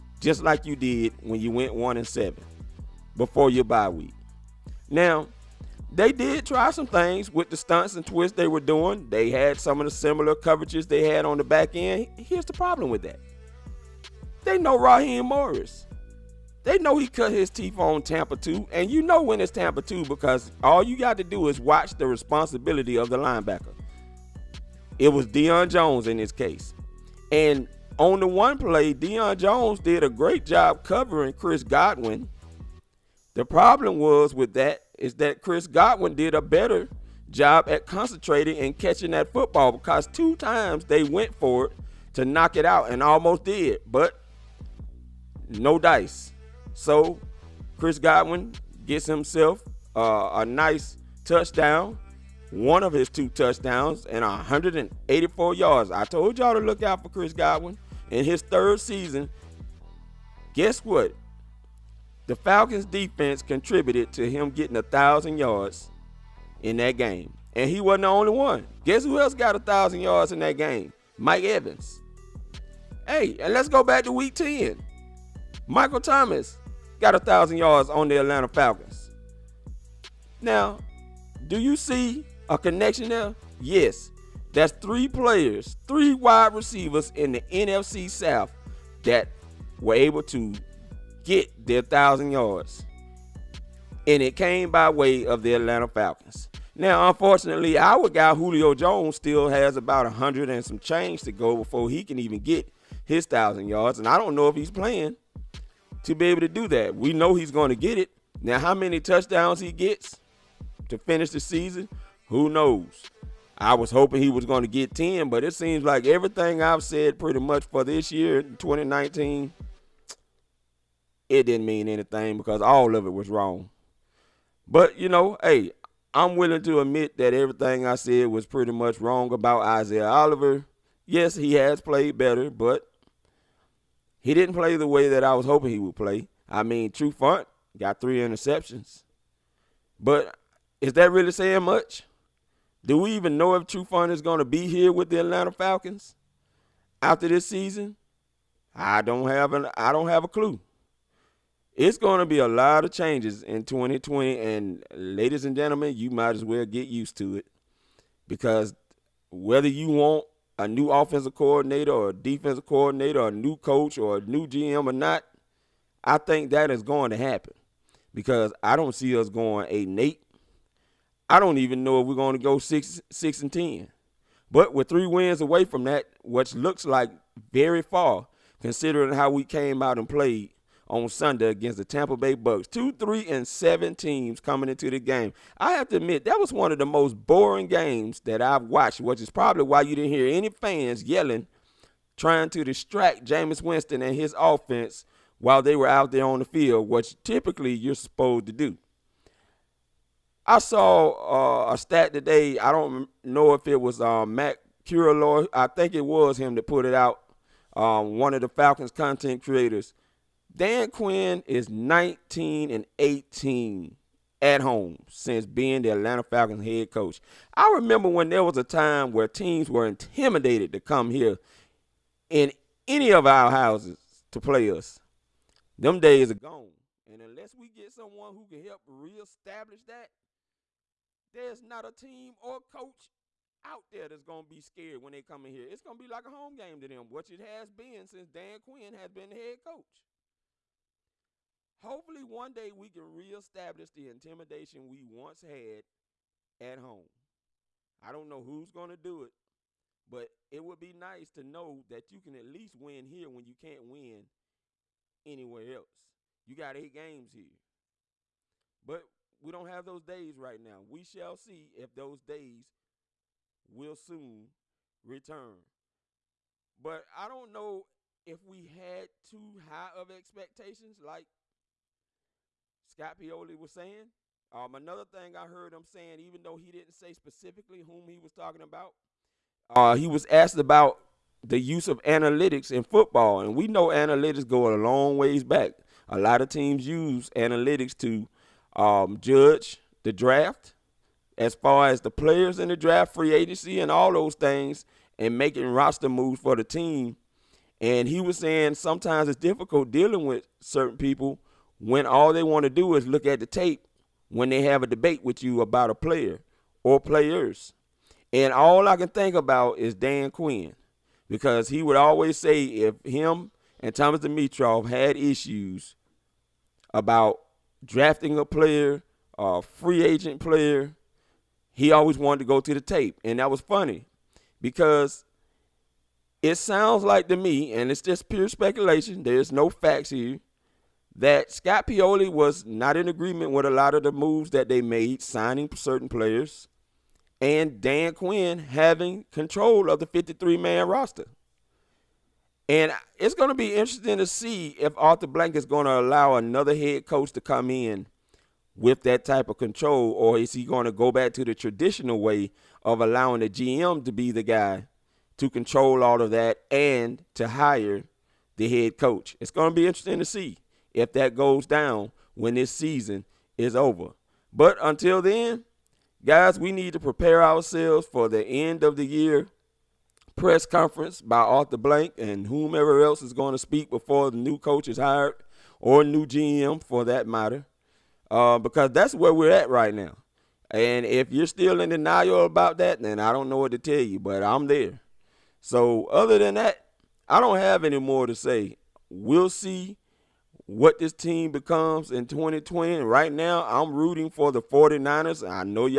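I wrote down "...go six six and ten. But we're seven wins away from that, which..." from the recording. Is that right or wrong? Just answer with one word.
wrong.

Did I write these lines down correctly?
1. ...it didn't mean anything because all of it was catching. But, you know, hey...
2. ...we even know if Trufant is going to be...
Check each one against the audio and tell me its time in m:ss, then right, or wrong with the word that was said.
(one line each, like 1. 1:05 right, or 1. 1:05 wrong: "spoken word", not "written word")
1. 2:01 wrong: "wrong", not "catching"
2. 2:22 right.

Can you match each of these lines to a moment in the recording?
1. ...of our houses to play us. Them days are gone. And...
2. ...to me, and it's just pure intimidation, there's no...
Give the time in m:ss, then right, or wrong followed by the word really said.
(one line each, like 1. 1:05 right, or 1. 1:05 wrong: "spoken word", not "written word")
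1. 3:43 right
2. 5:27 wrong: "speculation", not "intimidation".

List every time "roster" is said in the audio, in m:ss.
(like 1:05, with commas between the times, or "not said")
4:55, 5:40.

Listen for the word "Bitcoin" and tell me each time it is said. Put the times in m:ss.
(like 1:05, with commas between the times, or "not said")
not said.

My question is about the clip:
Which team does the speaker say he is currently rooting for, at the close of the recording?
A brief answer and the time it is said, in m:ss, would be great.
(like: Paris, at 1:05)
49ers, at 6:34.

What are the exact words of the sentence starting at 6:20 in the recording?
And if you're still in denial about that, then I don't know what to tell you, but I'm there.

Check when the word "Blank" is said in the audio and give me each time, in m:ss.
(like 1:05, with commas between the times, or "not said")
5:45, 6:11.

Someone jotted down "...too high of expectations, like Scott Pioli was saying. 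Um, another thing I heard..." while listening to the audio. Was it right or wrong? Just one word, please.
right.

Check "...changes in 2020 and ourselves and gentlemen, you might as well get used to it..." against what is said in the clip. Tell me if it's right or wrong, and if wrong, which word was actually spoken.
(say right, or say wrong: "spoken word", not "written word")
wrong: "ladies", not "ourselves".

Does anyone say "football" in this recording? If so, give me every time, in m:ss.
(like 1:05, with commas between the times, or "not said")
0:39, 4:42.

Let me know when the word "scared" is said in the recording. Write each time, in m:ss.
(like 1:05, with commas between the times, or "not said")
3:54.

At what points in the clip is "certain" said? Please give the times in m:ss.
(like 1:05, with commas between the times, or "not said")
5:00, 5:35.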